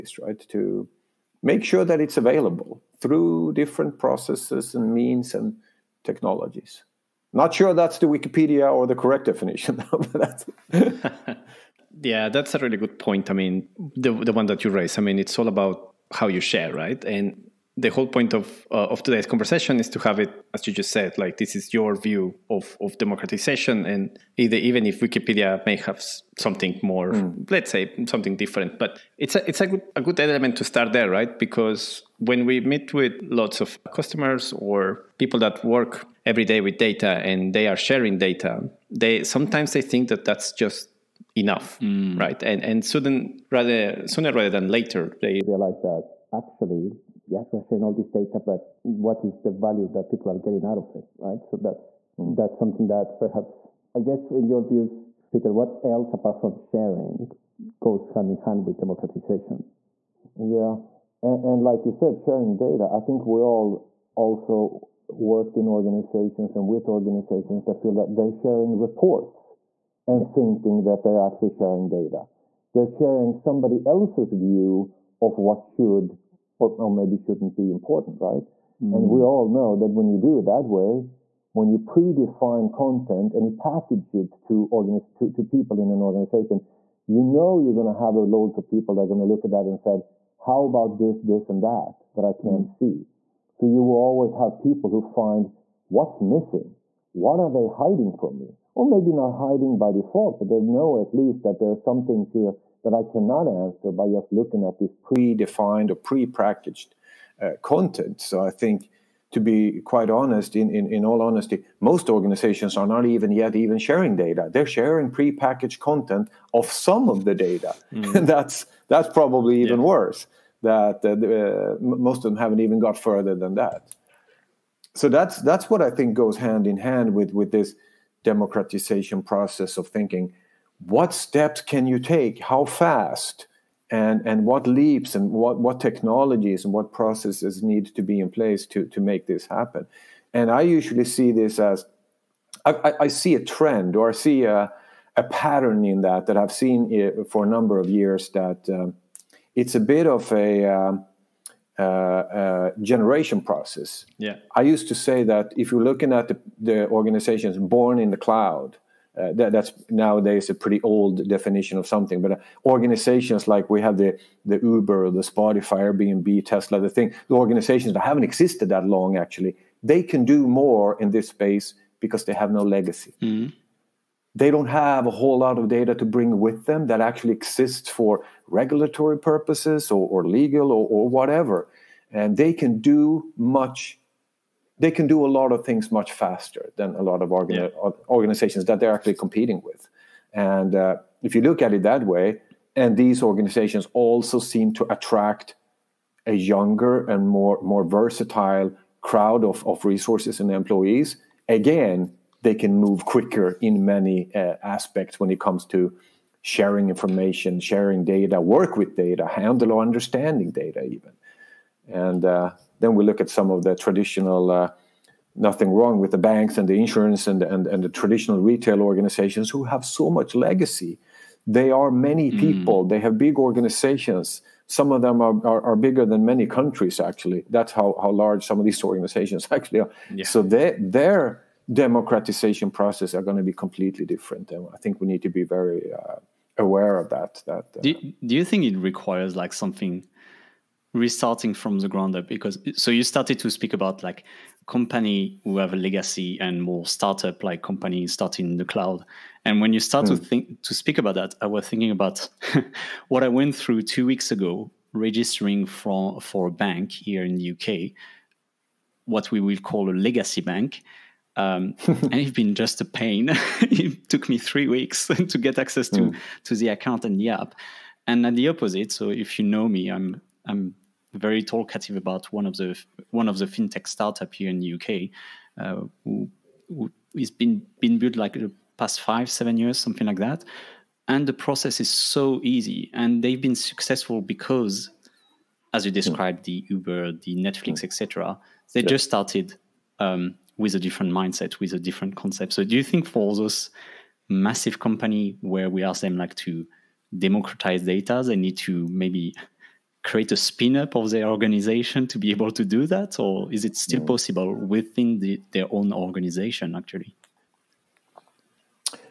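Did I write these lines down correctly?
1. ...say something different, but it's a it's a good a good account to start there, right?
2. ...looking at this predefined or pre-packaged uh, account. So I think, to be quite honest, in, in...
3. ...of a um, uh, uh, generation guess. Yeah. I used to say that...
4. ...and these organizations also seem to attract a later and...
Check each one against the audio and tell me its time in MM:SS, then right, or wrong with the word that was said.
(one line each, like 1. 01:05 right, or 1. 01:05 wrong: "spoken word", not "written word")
1. 00:27 wrong: "element", not "account"
2. 01:44 wrong: "content", not "account"
3. 02:30 wrong: "process", not "guess"
4. 03:12 wrong: "younger", not "later".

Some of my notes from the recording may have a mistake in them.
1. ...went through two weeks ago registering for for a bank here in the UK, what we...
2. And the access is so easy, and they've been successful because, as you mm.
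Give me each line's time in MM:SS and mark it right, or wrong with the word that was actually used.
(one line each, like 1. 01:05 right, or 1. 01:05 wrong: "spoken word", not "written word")
1. 04:13 right
2. 04:41 wrong: "process", not "access".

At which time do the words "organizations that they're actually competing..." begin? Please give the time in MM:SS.
03:08.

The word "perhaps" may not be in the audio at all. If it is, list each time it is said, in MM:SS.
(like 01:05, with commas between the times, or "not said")
00:53.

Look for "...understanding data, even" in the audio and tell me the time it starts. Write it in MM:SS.
03:29.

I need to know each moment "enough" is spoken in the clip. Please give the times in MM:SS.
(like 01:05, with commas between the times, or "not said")
00:41.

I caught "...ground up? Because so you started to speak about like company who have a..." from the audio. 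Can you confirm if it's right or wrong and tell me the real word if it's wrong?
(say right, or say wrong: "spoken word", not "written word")
right.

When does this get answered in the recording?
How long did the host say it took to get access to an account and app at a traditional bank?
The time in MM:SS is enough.
04:24.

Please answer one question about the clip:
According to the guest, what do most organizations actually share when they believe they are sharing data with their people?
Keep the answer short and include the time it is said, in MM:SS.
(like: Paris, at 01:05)
Pre-packaged content, at 01:55.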